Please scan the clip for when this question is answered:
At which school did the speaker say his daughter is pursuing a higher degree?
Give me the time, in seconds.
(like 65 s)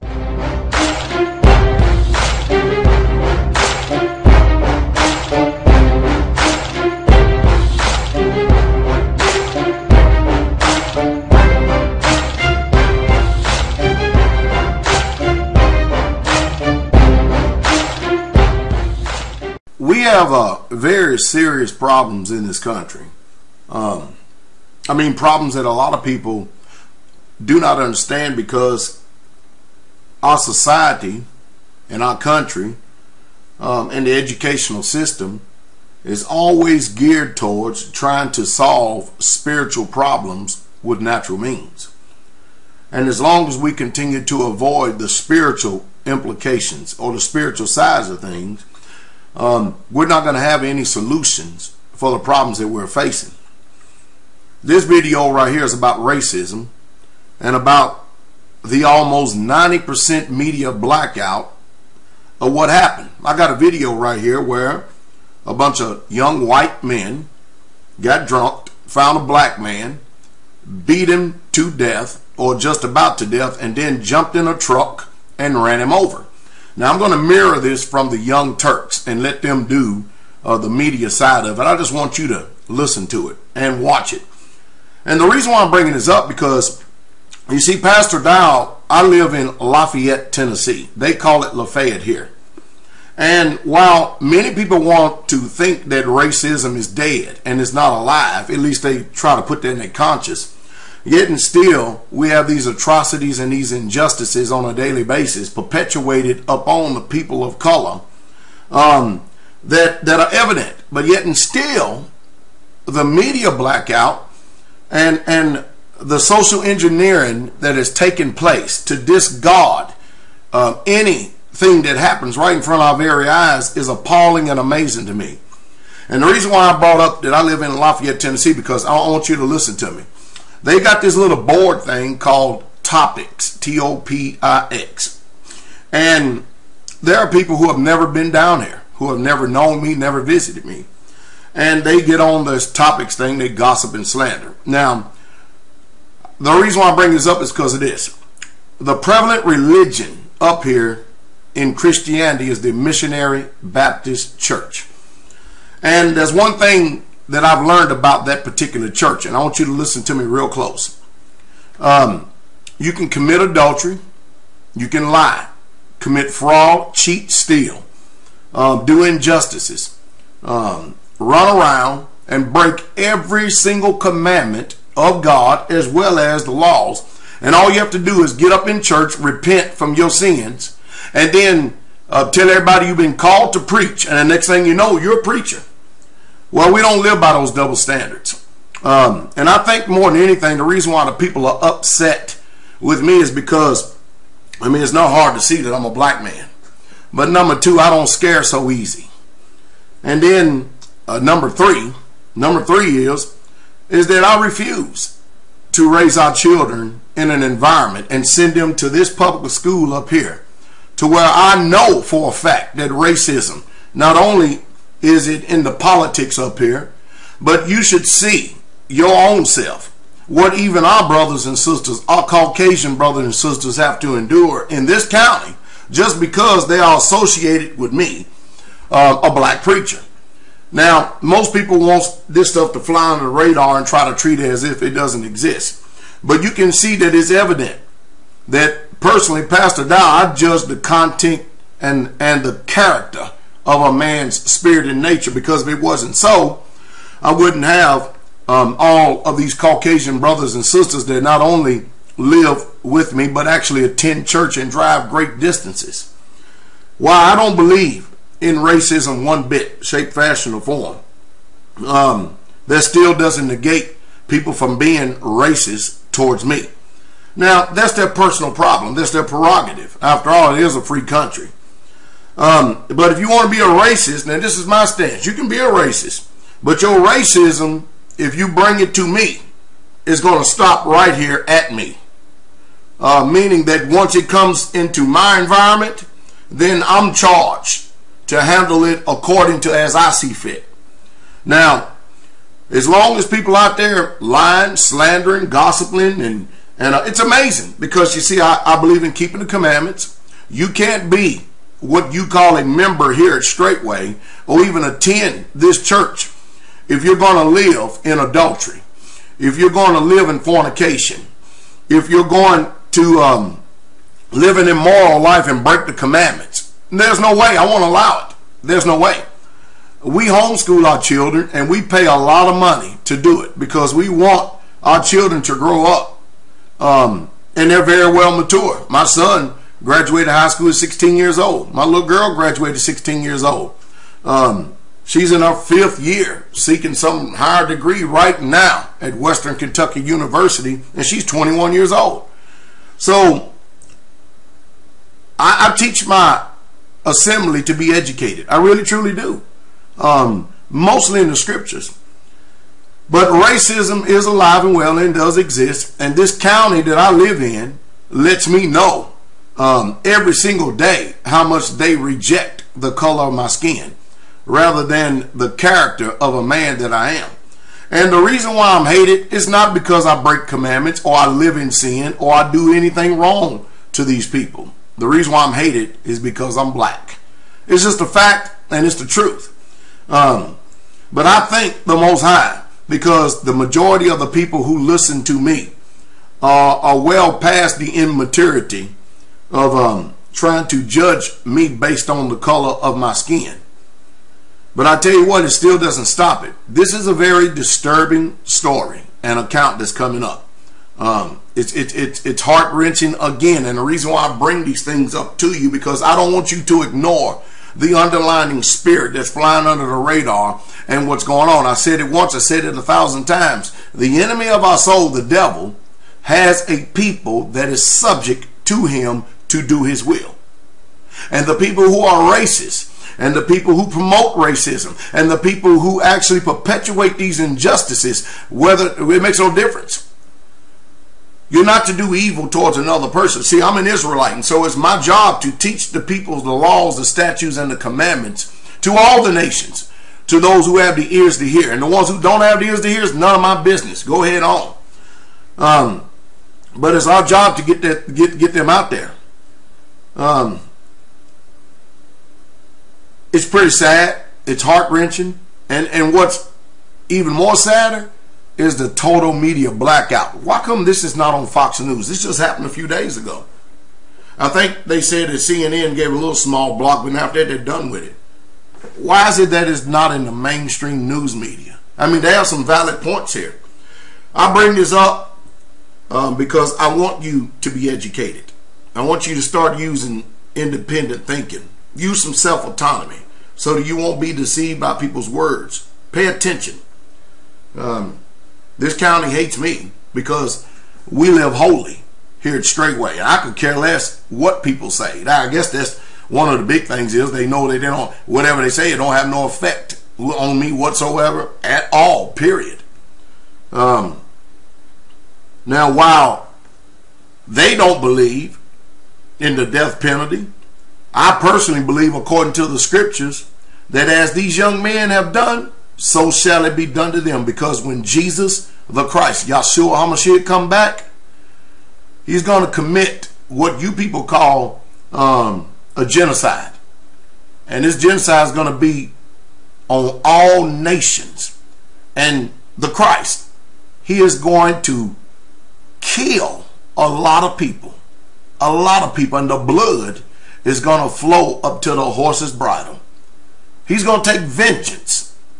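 339 s.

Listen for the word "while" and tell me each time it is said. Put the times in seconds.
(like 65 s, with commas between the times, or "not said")
93 s, 505 s.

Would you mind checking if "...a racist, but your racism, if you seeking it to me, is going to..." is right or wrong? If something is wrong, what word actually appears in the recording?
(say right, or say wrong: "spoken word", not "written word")
wrong: "bring", not "seeking".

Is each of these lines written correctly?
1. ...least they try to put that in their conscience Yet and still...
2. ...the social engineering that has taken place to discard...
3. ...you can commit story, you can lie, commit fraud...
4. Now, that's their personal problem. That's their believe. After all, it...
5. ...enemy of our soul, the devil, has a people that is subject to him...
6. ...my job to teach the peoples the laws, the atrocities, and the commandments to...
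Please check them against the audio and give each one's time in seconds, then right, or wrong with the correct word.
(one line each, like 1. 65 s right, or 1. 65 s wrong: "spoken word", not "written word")
1. 98 s right
2. 116 s right
3. 162 s wrong: "adultery", not "story"
4. 267 s wrong: "prerogative", not "believe"
5. 414 s right
6. 434 s wrong: "statutes", not "atrocities".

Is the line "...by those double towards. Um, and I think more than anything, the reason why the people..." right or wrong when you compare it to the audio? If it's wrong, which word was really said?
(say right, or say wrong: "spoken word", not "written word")
wrong: "standards", not "towards".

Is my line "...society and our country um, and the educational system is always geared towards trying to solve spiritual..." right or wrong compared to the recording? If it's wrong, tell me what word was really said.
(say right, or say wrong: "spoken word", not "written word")
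right.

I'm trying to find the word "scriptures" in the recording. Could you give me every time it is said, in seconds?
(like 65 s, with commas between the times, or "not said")
351 s, 512 s.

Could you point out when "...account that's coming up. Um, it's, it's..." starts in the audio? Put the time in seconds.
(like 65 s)
399 s.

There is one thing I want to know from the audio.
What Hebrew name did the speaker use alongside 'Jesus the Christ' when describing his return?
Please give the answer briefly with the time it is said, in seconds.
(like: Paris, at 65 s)
Yahshua HaMashiach, at 519 s.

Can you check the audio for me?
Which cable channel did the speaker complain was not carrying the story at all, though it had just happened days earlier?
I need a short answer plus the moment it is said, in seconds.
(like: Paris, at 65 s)
Fox News, at 461 s.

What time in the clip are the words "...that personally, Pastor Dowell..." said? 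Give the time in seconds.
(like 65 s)
238 s.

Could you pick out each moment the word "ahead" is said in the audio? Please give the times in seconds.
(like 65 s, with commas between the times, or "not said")
444 s.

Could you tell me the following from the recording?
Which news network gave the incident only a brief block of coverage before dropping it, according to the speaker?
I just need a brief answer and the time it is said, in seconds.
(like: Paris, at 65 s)
CNN, at 465 s.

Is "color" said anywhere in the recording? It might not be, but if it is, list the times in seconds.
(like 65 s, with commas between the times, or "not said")
107 s, 362 s, 392 s.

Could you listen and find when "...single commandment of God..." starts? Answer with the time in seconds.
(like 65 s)
173 s.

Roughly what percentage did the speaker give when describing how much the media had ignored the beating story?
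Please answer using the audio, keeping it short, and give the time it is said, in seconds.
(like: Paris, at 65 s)
90%, at 59 s.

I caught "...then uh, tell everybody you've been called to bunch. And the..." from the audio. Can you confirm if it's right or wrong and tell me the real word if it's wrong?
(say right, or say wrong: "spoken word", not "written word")
wrong: "preach", not "bunch".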